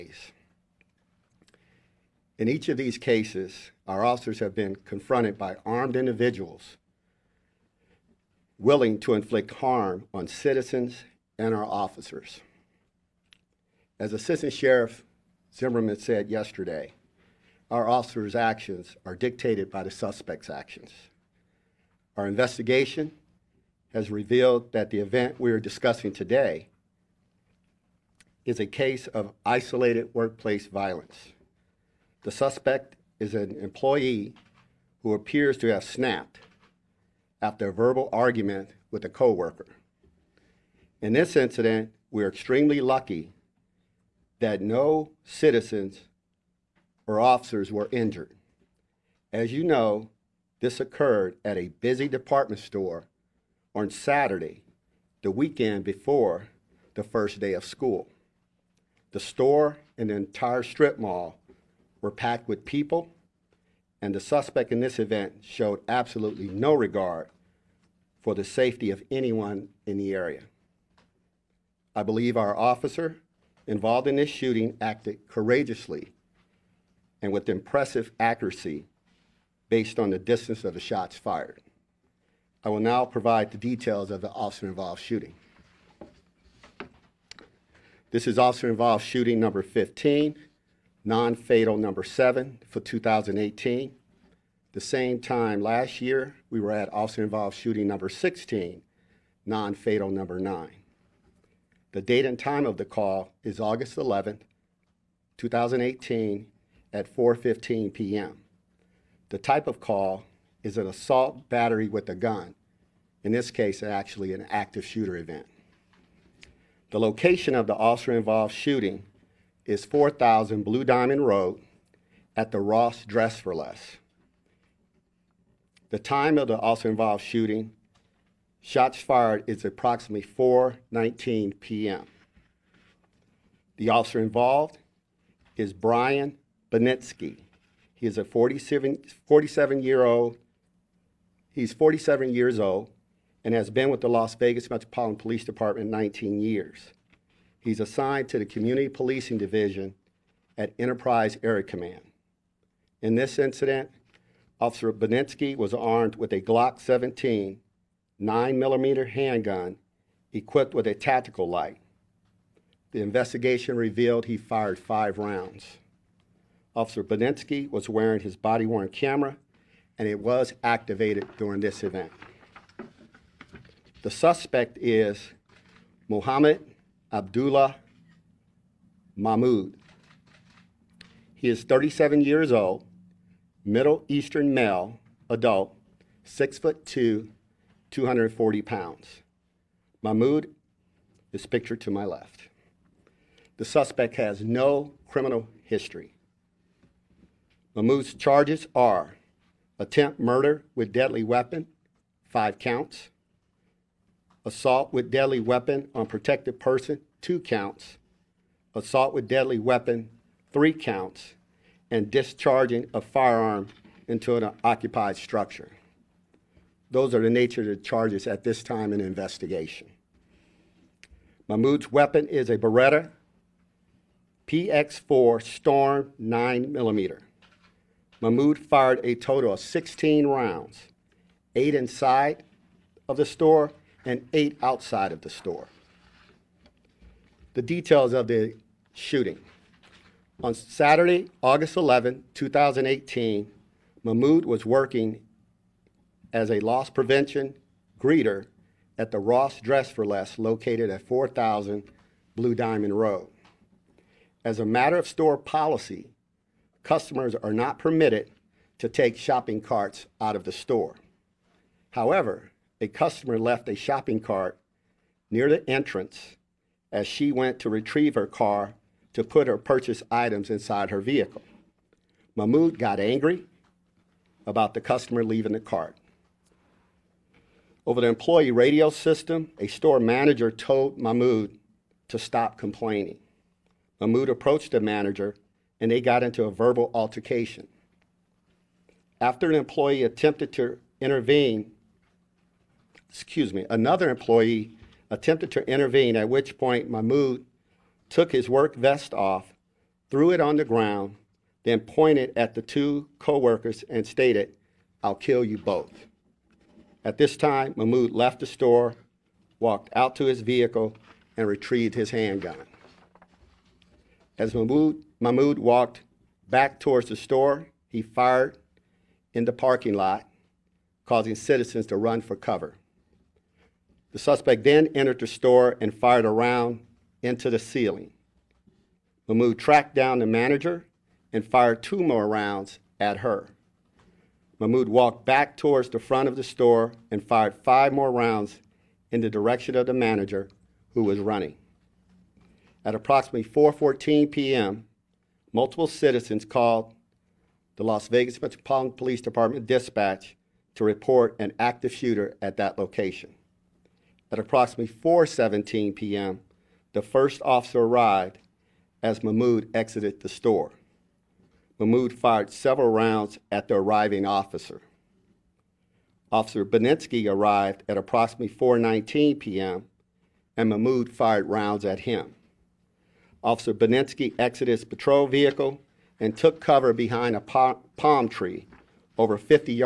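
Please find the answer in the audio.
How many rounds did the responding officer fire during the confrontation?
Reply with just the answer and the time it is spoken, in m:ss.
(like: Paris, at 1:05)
5, at 2:44.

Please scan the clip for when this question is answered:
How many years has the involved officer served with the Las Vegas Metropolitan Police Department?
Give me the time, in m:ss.
2:25.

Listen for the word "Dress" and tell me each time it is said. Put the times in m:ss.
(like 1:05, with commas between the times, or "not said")
2:03, 4:09.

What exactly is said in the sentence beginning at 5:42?
At approximately 4:14 p.m., multiple citizens called the Las Vegas Metropolitan Police Department dispatch to report an active shooter at that location.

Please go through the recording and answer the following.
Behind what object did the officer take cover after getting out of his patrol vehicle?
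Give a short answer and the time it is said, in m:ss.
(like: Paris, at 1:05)
palm tree, at 6:17.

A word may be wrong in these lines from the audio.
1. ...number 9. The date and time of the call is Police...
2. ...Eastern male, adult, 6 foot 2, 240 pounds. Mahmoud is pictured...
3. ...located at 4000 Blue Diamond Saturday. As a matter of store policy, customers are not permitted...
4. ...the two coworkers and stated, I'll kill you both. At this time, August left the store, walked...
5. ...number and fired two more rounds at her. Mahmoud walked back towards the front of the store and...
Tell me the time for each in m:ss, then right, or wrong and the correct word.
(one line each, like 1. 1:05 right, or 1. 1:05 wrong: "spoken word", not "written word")
1. 1:40 wrong: "August", not "Police"
2. 3:04 right
3. 4:10 wrong: "Road", not "Saturday"
4. 5:02 wrong: "Mahmoud", not "August"
5. 5:30 wrong: "manager", not "number".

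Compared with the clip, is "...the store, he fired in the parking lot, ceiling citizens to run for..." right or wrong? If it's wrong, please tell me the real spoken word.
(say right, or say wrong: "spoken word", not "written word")
wrong: "causing", not "ceiling".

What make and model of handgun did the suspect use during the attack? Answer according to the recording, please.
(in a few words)
Beretta PX4 Storm.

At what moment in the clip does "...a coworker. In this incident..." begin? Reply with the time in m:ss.
0:39.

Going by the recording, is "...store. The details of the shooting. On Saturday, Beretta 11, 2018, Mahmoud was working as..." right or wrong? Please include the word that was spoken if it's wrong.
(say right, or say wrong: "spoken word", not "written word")
wrong: "August", not "Beretta".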